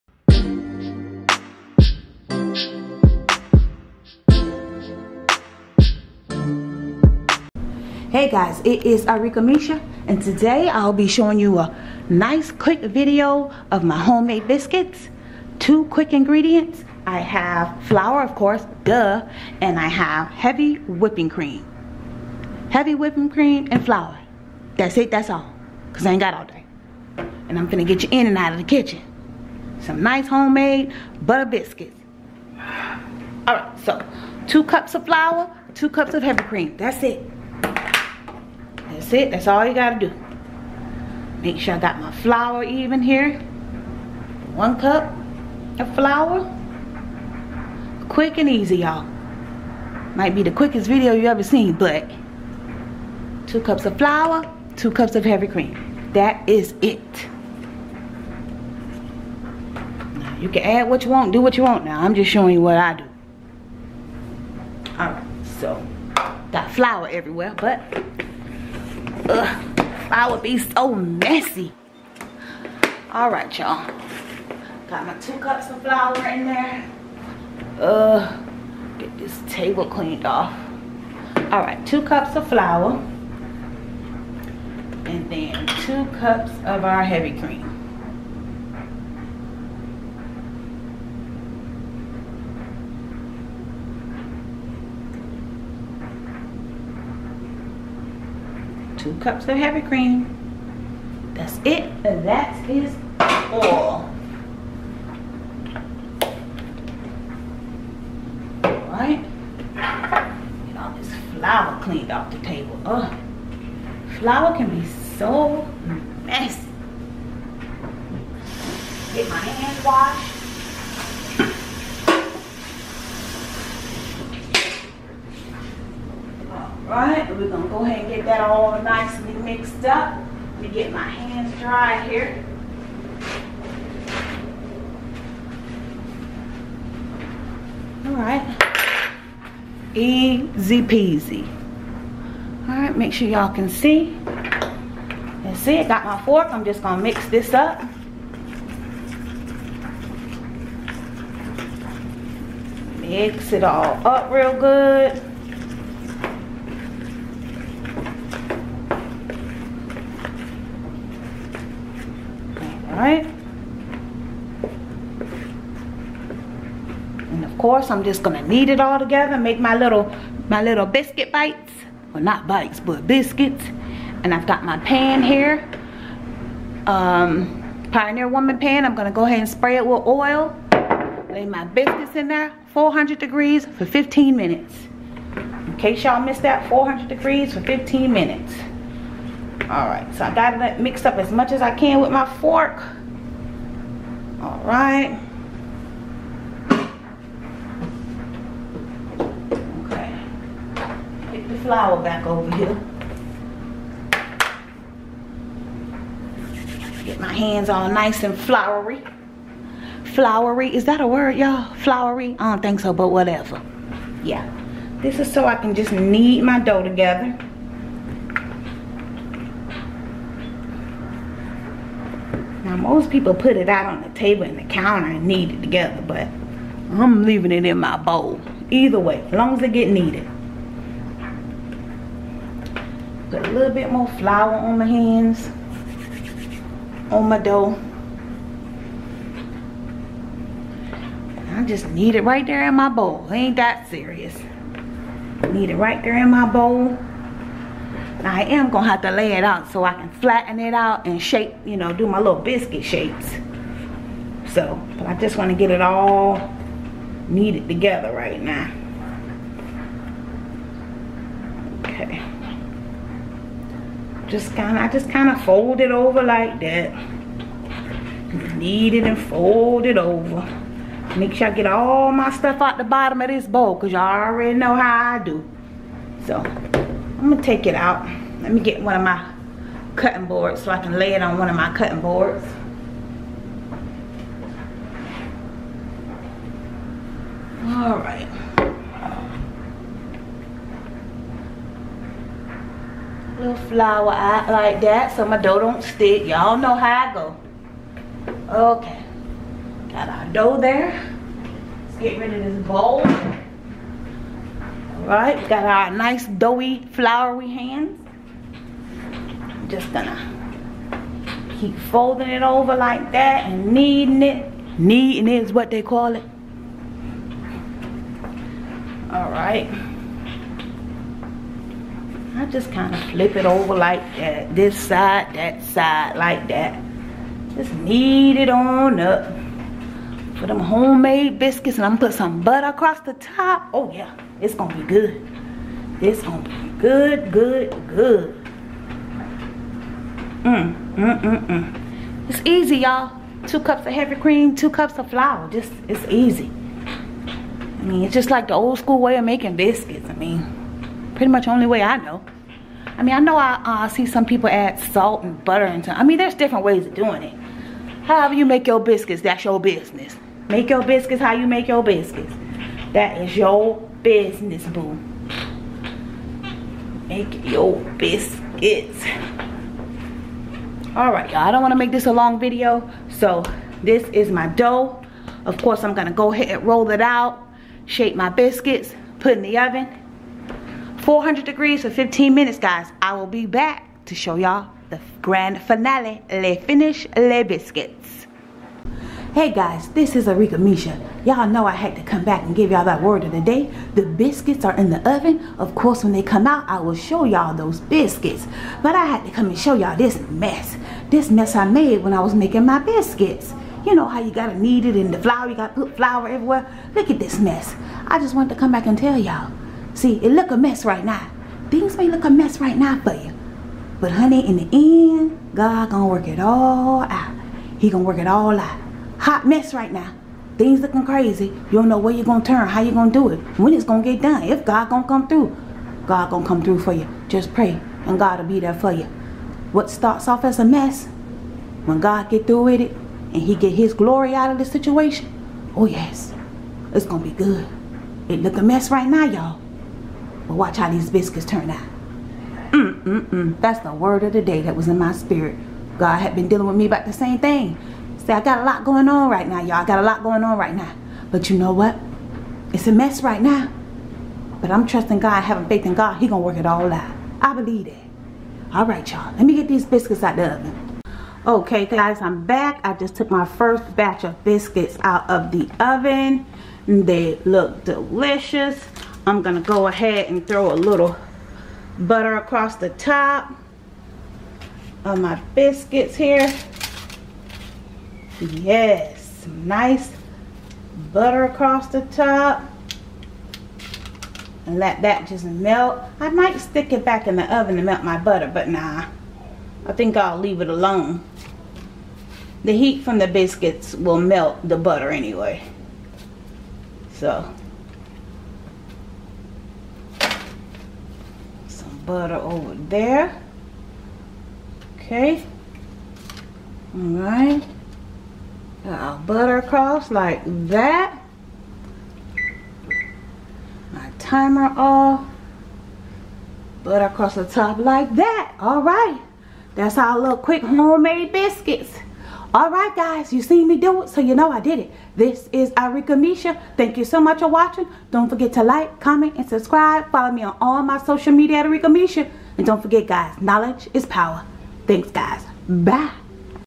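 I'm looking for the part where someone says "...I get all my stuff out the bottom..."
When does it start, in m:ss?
4:31.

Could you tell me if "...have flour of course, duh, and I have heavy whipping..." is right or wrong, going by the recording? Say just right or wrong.
right.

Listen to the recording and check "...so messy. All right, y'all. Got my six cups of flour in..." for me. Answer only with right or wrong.
wrong.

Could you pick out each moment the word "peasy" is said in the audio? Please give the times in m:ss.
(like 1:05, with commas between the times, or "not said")
2:20.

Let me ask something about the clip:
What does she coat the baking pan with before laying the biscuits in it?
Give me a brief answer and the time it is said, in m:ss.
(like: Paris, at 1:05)
oil, at 3:00.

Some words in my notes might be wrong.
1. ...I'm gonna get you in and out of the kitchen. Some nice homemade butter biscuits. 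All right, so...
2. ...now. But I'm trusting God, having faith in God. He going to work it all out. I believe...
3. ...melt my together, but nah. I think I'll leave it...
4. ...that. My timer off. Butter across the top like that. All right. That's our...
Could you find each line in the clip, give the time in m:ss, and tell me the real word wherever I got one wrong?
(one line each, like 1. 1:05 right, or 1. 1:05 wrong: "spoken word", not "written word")
1. 0:27 right
2. 7:33 right
3. 8:07 wrong: "butter", not "together"
4. 8:30 right.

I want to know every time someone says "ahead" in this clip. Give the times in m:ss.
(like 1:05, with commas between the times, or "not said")
2:07, 2:59, 6:16, 7:49.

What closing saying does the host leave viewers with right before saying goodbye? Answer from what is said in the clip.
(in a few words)
knowledge is power.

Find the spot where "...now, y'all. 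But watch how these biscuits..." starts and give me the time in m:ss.
7:19.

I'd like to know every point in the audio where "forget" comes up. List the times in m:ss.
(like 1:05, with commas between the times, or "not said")
8:48, 8:52.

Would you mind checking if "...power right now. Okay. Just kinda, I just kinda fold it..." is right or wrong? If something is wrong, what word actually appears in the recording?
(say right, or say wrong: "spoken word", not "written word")
wrong: "together", not "power".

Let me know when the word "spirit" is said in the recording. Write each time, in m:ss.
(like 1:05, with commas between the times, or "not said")
7:25.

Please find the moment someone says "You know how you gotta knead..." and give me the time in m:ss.
6:43.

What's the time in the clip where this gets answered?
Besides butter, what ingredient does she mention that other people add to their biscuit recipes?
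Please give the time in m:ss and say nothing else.
5:54.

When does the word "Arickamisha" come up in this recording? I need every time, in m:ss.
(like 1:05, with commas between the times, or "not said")
0:09, 6:30, 8:45, 8:51.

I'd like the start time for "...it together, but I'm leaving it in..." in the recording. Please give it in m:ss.
3:45.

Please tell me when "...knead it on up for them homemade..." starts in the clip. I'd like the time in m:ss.
5:27.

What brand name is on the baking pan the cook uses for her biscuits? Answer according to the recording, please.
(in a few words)
Pioneer Woman.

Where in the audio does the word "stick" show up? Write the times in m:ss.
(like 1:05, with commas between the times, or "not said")
4:55, 8:06.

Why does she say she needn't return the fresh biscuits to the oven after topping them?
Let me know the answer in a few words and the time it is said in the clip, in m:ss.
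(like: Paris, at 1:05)
melt the butter, at 8:14.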